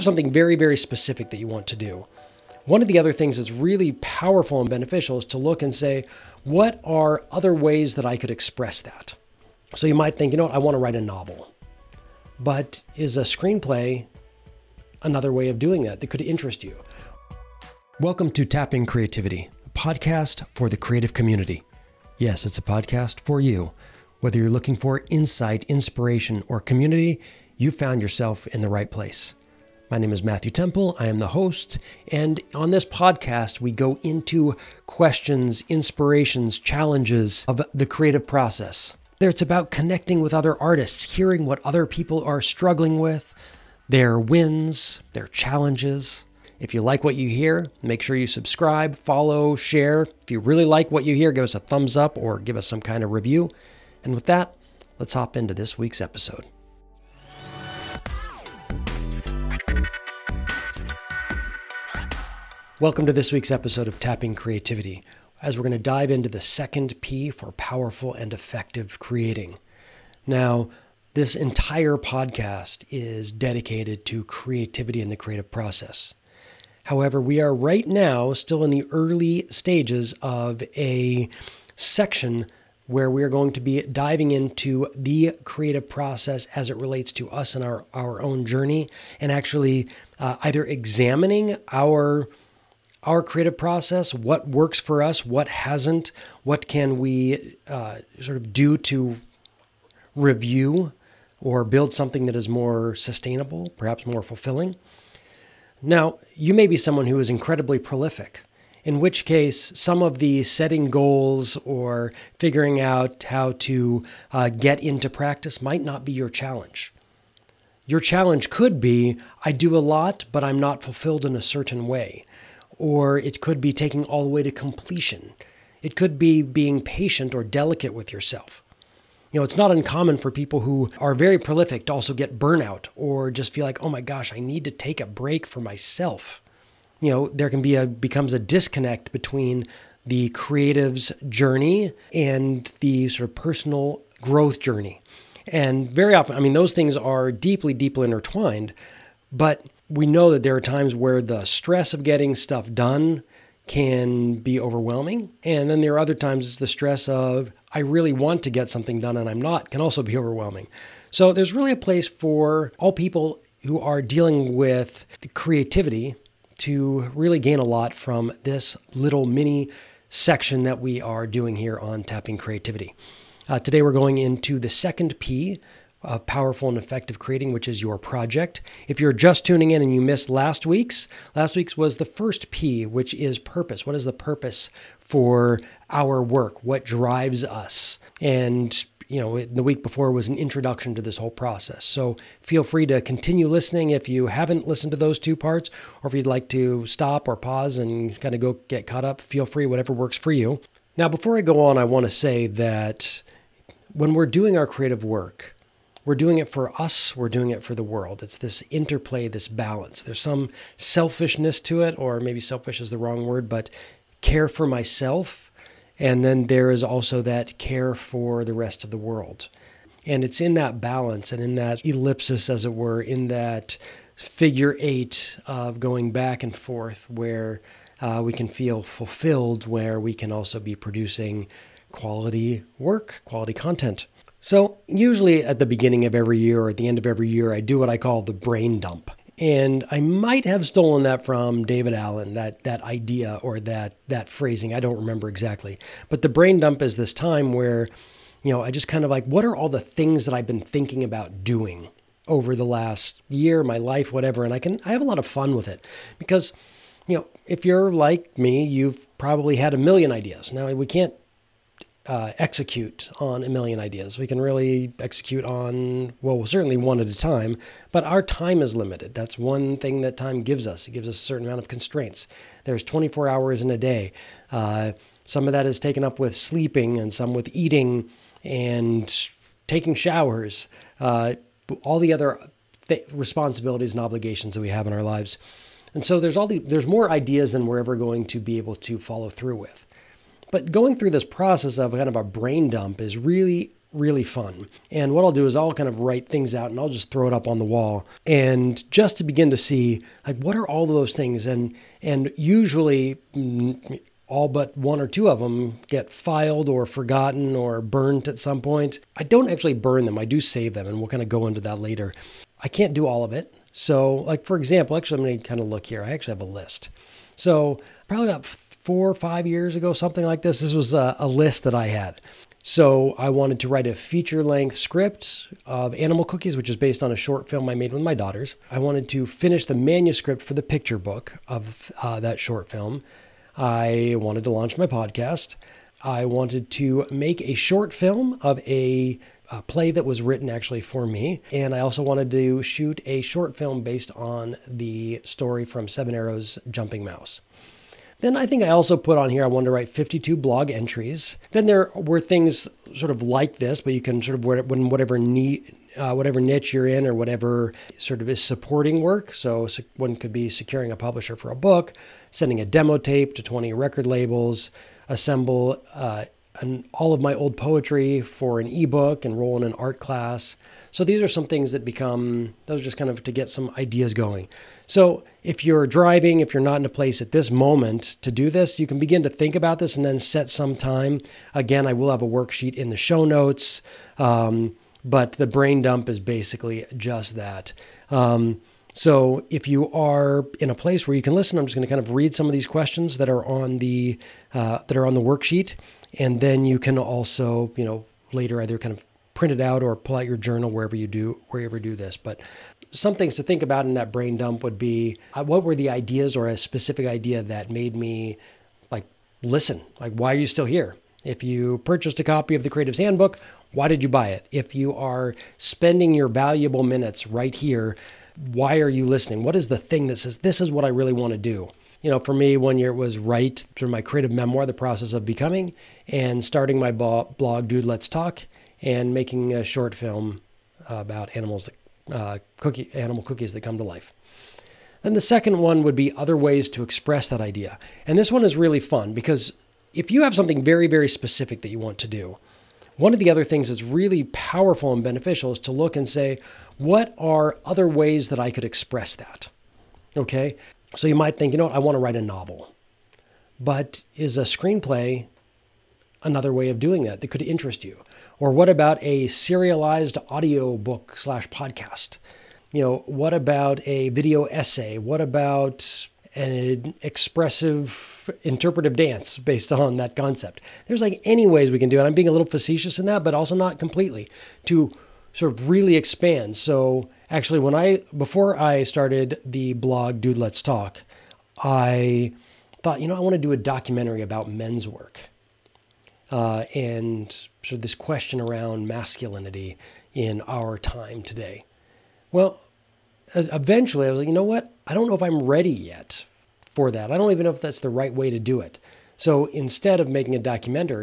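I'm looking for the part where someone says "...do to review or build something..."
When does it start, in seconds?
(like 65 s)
98 s.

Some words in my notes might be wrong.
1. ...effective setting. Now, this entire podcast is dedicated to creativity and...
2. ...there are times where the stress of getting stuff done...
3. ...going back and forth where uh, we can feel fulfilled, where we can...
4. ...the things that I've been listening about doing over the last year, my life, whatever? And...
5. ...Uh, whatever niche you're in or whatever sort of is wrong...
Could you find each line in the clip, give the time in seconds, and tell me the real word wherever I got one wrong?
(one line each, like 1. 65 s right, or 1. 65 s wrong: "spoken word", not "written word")
1. 68 s wrong: "creating", not "setting"
2. 150 s right
3. 225 s right
4. 249 s wrong: "thinking", not "listening"
5. 355 s wrong: "supporting", not "wrong".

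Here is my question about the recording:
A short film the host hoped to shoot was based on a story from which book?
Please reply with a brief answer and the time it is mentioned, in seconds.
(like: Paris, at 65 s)
Seven Arrows, at 345 s.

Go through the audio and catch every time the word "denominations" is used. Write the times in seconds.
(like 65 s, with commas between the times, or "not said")
not said.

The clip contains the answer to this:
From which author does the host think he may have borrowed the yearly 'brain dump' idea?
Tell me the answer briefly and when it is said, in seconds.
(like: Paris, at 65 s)
David Allen, at 241 s.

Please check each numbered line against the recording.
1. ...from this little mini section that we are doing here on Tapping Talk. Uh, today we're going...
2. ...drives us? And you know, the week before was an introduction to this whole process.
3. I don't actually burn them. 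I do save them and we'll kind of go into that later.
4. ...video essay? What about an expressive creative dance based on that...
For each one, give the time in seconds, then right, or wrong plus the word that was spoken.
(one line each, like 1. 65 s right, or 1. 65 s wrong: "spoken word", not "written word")
1. 167 s wrong: "Creativity", not "Talk"
2. 186 s right
3. 309 s right
4. 464 s wrong: "interpretive", not "creative".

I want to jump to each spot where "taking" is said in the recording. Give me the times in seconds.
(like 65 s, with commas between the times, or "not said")
123 s, 279 s.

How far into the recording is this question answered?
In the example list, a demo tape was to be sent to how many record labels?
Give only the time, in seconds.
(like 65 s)
363 s.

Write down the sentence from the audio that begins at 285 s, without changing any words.
And so there's all the, there's more ideas than we're ever going to be able to follow through with.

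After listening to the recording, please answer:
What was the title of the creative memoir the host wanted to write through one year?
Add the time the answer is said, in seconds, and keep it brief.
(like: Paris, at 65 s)
The Process of Becoming, at 424 s.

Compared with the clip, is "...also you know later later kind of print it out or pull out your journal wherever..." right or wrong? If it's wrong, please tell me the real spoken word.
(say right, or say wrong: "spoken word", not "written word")
wrong: "either", not "later".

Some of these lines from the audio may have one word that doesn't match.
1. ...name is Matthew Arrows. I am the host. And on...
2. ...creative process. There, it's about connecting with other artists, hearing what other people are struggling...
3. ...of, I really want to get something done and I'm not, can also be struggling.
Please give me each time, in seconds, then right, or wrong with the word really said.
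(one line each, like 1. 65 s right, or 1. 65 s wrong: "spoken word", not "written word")
1. 29 s wrong: "Temple", not "Arrows"
2. 37 s right
3. 157 s wrong: "overwhelming", not "struggling".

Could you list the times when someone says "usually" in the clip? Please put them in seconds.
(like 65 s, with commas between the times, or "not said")
234 s, 302 s.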